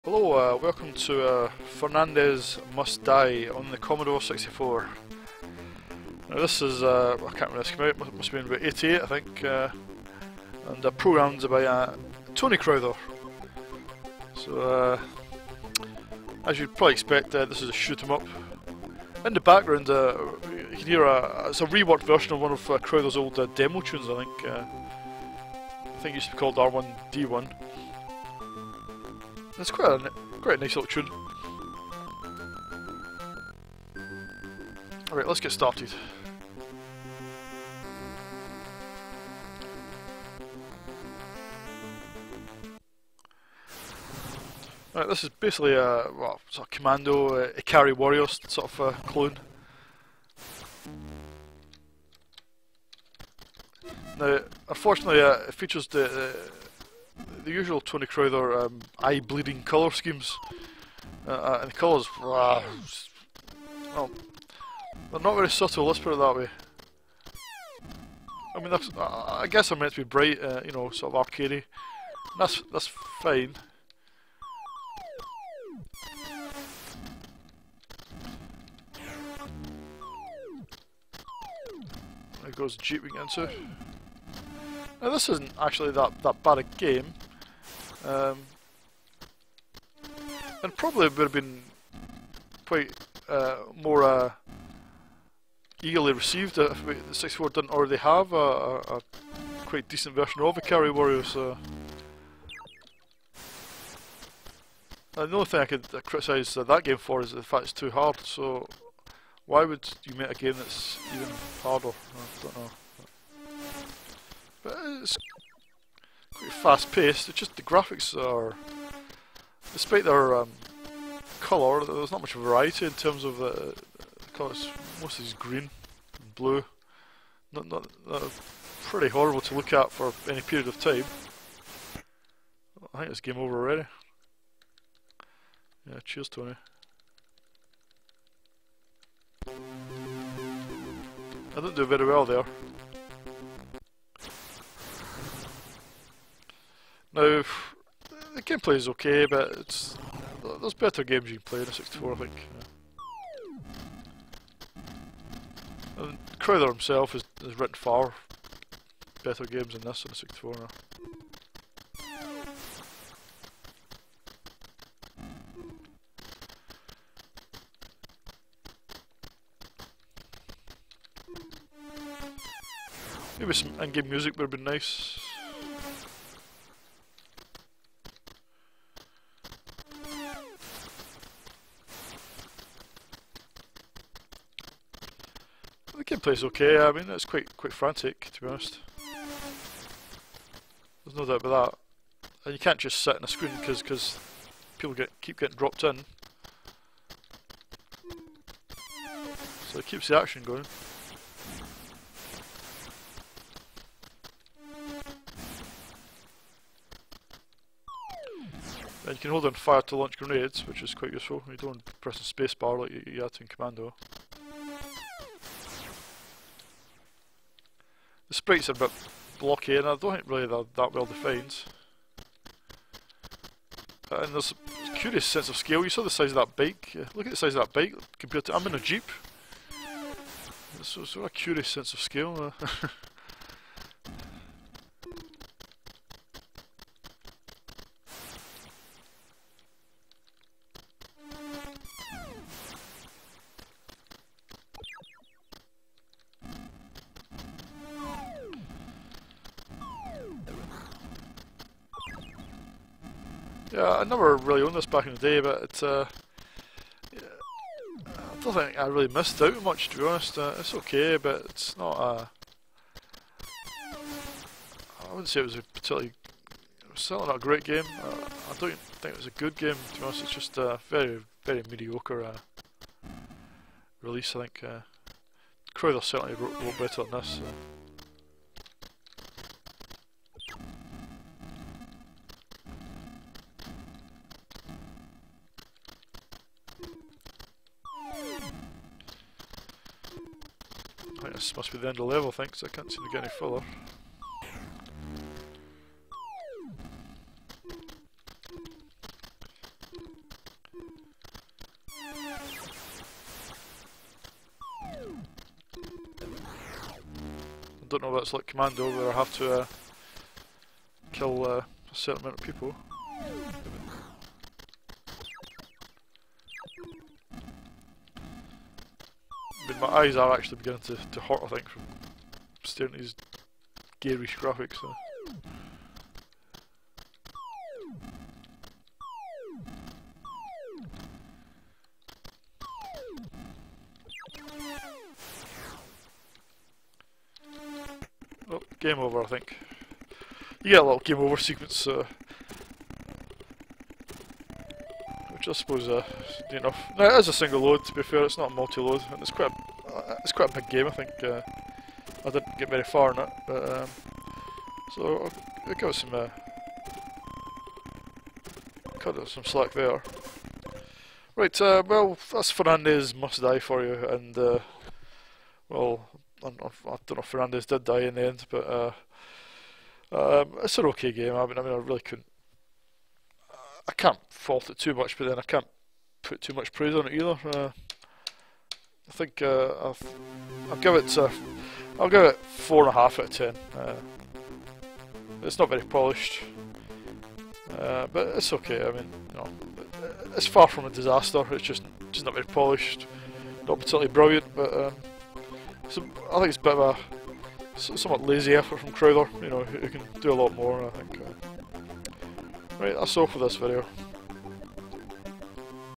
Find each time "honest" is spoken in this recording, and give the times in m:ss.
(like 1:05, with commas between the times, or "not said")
3:08, 4:20, 4:30.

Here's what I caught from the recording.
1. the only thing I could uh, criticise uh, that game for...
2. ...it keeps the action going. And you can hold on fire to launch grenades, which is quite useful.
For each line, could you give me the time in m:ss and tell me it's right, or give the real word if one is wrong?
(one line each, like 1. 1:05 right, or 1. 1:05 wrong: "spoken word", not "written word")
1. 1:45 right
2. 3:19 right.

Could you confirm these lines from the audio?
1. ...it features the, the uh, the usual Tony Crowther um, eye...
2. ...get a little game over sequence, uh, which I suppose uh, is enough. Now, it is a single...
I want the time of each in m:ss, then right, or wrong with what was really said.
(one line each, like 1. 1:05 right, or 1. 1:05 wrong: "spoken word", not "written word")
1. 0:55 right
2. 5:40 right.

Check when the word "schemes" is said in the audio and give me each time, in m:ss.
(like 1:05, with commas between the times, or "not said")
0:59.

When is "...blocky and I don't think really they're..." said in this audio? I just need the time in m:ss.
3:39.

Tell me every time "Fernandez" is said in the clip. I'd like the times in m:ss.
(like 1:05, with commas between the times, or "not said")
0:01, 6:02, 6:07.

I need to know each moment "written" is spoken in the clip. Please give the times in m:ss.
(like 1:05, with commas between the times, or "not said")
2:37.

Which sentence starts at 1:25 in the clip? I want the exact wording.
Now this isn't actually that, that bad a game.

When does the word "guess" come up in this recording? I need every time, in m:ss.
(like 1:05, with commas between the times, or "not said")
1:09.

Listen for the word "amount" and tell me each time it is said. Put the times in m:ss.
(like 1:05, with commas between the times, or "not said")
5:12.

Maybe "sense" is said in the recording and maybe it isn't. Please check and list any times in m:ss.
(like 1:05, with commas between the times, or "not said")
3:45, 3:51.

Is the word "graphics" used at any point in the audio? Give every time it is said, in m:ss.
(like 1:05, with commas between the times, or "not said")
1:57, 5:24.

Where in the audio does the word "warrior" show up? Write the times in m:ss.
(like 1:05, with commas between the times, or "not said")
0:47, 1:40.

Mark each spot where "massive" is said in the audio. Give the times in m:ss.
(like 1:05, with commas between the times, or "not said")
not said.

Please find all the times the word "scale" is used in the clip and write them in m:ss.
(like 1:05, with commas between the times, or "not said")
3:45, 3:51.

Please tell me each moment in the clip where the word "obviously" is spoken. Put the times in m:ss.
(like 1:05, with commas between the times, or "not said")
not said.